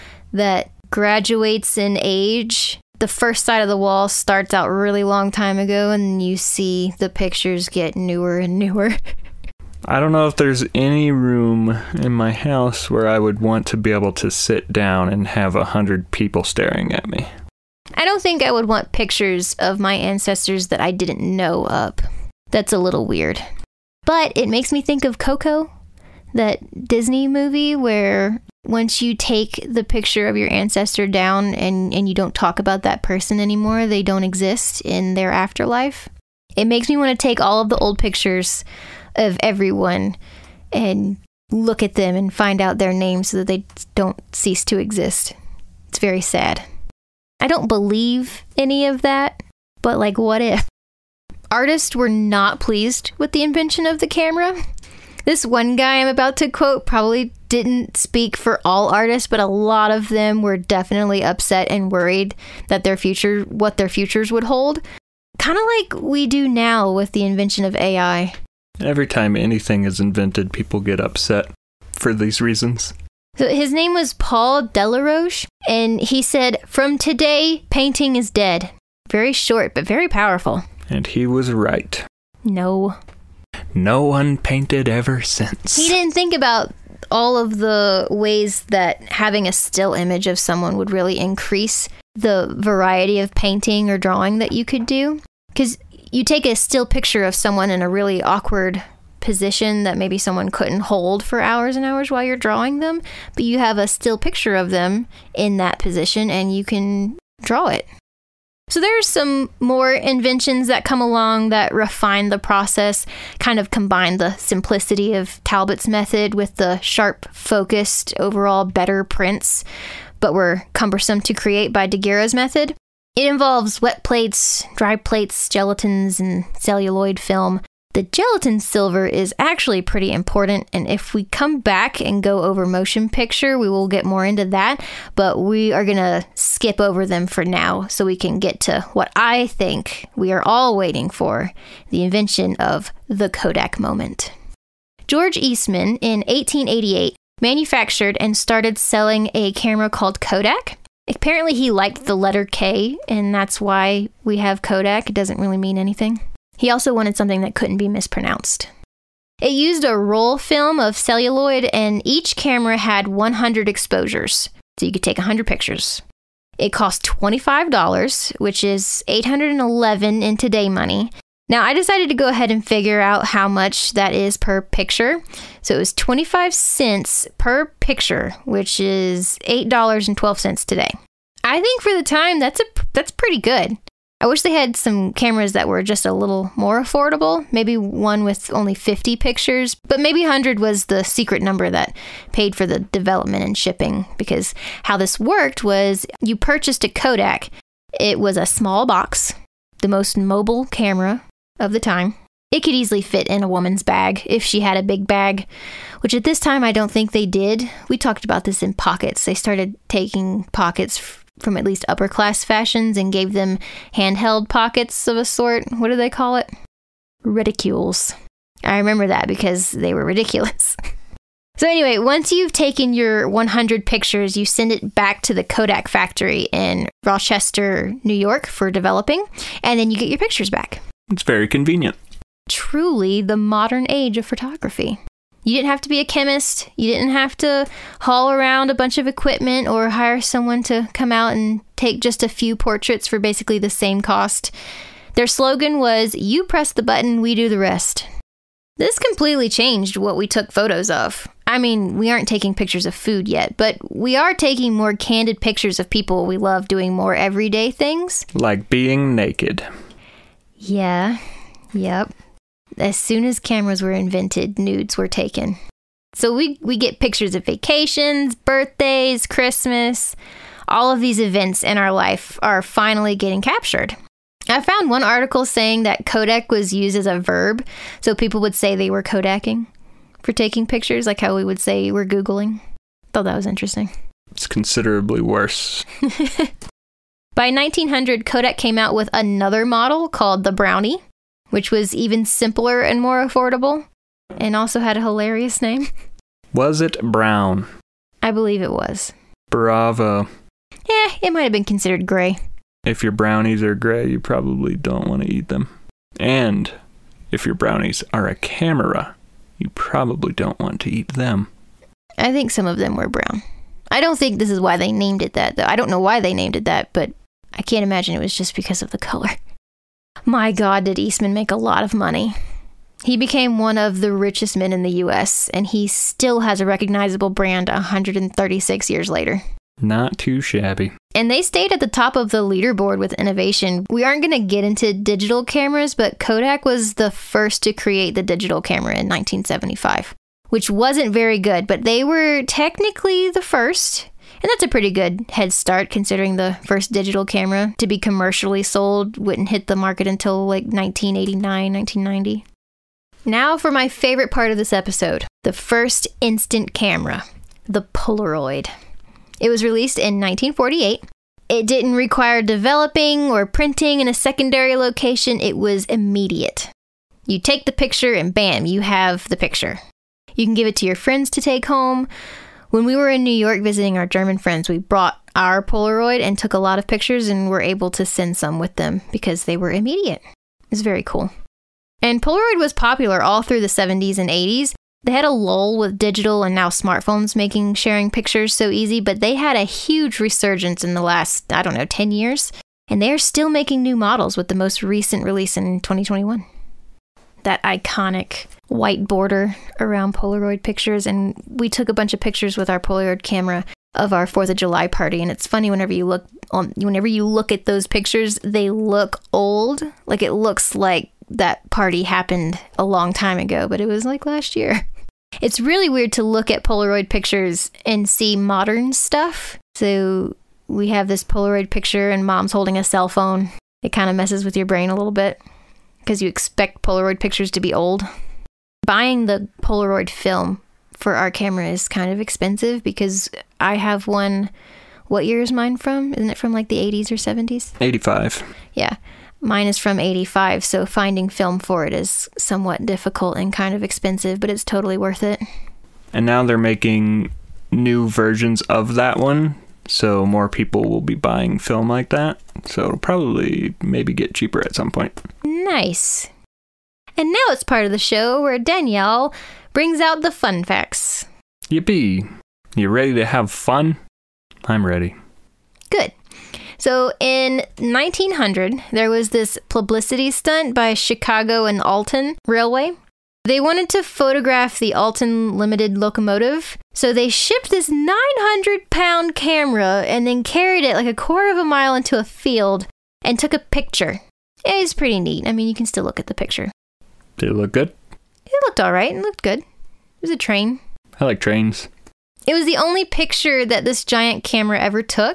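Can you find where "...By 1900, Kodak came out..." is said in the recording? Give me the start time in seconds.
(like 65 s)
287 s.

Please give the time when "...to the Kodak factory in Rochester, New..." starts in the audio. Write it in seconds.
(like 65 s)
225 s.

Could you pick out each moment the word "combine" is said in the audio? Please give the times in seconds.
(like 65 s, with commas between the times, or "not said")
113 s.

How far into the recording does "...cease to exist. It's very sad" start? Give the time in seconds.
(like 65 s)
44 s.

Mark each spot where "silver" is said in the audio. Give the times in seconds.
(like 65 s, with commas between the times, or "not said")
128 s.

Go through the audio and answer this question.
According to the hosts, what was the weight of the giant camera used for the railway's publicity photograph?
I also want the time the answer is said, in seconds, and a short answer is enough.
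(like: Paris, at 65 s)
900 pounds, at 477 s.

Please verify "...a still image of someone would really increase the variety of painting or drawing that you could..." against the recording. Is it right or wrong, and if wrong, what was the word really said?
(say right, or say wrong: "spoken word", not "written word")
right.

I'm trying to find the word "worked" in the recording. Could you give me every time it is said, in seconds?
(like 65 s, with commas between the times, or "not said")
195 s.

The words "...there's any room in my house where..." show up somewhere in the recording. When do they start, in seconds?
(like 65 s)
10 s.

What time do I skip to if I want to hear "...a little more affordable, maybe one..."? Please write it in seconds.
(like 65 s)
186 s.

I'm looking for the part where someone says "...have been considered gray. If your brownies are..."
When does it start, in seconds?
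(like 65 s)
301 s.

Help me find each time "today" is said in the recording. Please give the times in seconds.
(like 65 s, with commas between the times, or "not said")
76 s, 170 s, 180 s.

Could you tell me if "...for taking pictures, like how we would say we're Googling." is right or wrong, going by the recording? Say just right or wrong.
right.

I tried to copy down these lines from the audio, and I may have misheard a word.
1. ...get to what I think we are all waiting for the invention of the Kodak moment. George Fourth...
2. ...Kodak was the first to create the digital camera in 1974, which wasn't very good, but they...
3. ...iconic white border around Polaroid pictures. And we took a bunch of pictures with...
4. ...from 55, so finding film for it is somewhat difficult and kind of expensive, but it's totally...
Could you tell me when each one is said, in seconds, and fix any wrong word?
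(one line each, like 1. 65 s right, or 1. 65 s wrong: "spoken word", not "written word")
1. 138 s wrong: "Eastman", not "Fourth"
2. 336 s wrong: "1975", not "1974"
3. 397 s right
4. 439 s wrong: "85", not "55".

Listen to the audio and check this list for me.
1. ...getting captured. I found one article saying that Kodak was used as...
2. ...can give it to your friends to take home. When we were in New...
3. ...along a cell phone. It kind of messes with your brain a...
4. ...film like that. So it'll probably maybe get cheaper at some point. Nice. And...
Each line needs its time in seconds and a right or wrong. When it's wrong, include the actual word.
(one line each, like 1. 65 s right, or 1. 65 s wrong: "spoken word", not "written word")
1. 273 s right
2. 370 s right
3. 422 s wrong: "holding", not "along"
4. 451 s right.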